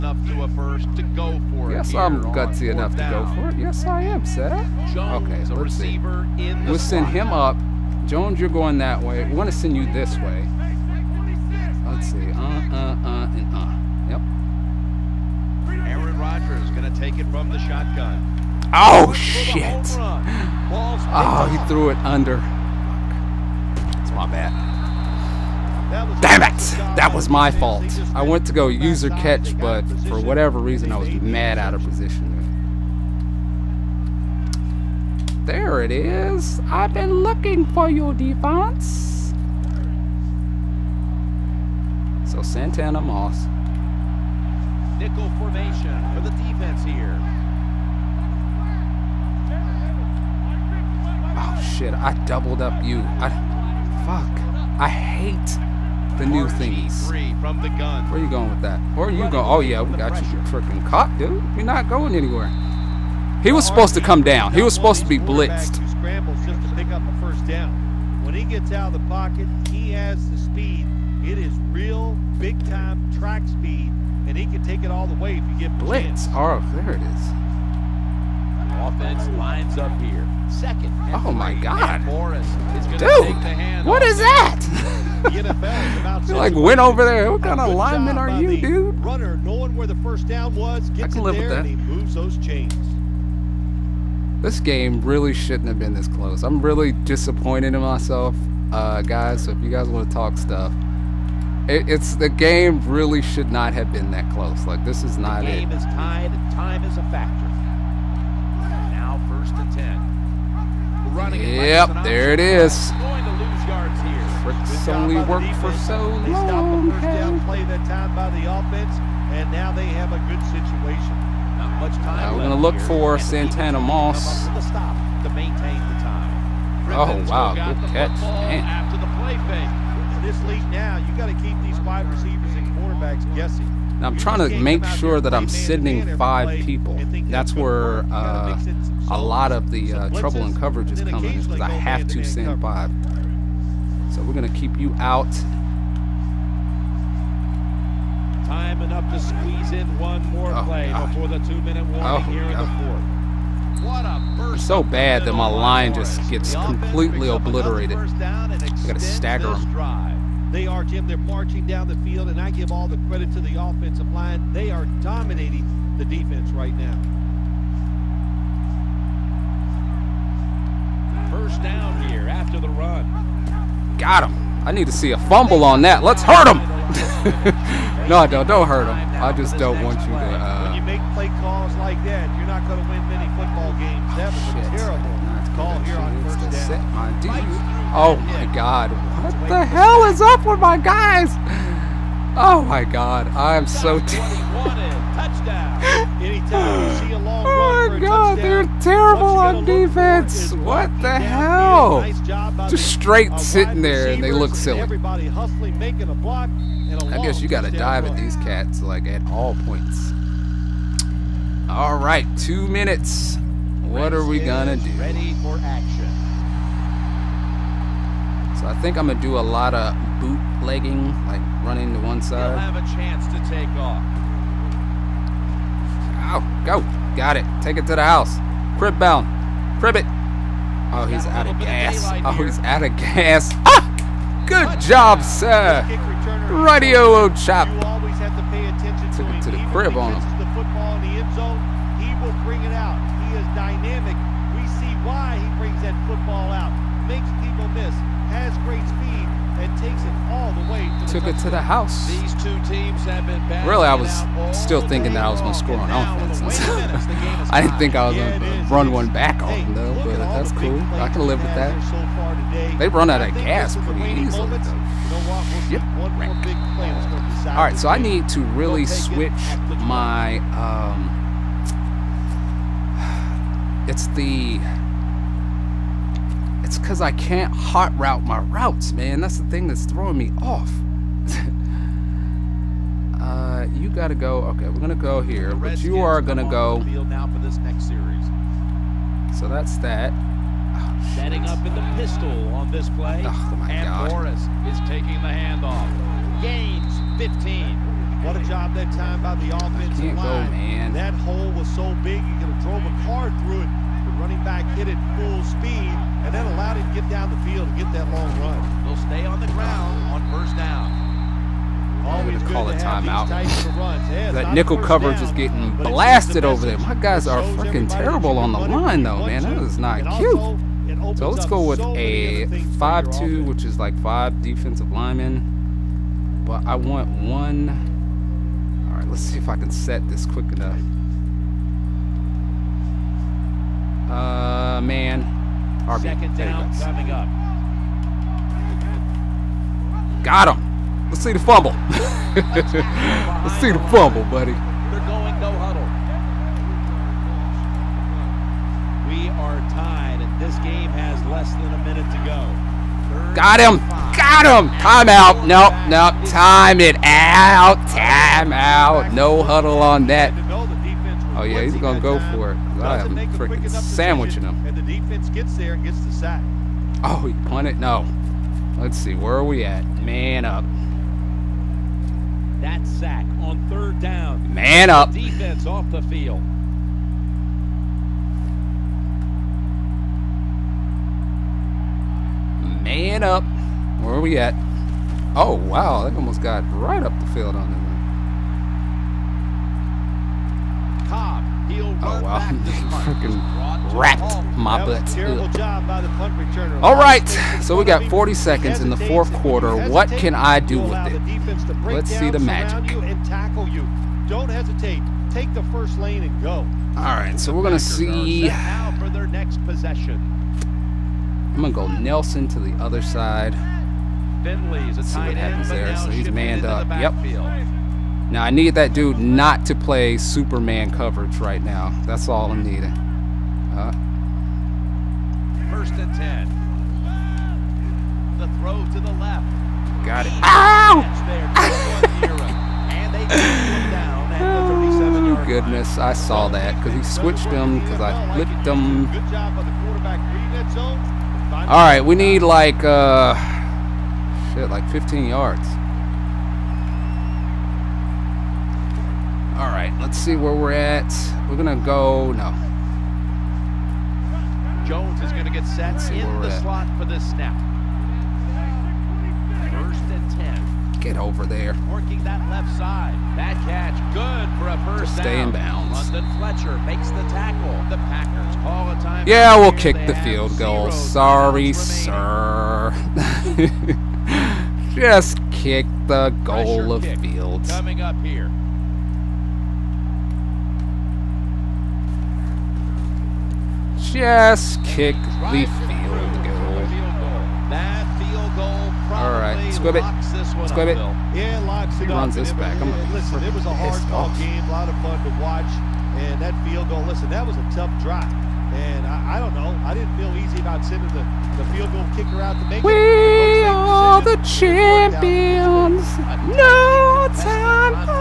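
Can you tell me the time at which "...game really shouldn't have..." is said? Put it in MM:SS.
01:34.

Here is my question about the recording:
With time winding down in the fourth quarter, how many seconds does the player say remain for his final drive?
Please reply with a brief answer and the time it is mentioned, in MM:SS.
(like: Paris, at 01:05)
40, at 06:38.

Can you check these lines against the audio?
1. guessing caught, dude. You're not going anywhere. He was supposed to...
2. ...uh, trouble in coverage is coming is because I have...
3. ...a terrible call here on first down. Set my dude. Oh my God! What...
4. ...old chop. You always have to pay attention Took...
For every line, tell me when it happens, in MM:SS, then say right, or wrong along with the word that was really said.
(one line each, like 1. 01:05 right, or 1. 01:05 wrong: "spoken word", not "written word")
1. 01:00 wrong: "freaking", not "guessing"
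2. 02:19 right
3. 03:04 right
4. 03:57 right.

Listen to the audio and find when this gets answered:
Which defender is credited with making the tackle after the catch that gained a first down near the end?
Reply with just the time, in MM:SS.
07:46.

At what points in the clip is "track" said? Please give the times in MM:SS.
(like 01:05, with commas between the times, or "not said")
01:13.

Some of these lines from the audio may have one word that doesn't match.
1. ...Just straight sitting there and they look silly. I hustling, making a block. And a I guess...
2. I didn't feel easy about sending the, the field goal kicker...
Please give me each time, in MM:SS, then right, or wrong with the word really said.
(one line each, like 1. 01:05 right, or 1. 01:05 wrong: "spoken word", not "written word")
1. 03:22 right
2. 08:19 right.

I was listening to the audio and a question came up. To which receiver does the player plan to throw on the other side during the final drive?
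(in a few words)
Nelson.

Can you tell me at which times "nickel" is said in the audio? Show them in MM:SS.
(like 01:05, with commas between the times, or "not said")
00:44, 05:14.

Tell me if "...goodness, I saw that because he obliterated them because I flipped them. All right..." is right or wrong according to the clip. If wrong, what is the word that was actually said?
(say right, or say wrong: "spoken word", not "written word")
wrong: "switched", not "obliterated".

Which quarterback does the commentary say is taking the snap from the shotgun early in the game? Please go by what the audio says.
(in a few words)
Aaron Rodgers.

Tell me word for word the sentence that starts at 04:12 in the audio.
These two teams have been Really, I was still thinking that I was going to score on offense.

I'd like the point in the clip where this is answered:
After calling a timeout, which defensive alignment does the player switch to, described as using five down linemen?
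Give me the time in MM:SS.
05:22.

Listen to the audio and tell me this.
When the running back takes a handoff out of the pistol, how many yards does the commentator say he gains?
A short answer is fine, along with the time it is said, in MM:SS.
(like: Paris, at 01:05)
15, at 04:56.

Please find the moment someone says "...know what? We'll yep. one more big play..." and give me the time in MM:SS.
04:25.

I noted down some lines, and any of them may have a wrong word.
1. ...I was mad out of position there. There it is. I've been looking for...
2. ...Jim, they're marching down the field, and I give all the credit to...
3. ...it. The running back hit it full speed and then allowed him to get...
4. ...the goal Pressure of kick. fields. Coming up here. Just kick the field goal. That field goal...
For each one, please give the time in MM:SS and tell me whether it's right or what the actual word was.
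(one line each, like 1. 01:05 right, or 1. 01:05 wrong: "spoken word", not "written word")
1. 00:30 right
2. 02:40 right
3. 05:03 right
4. 07:56 right.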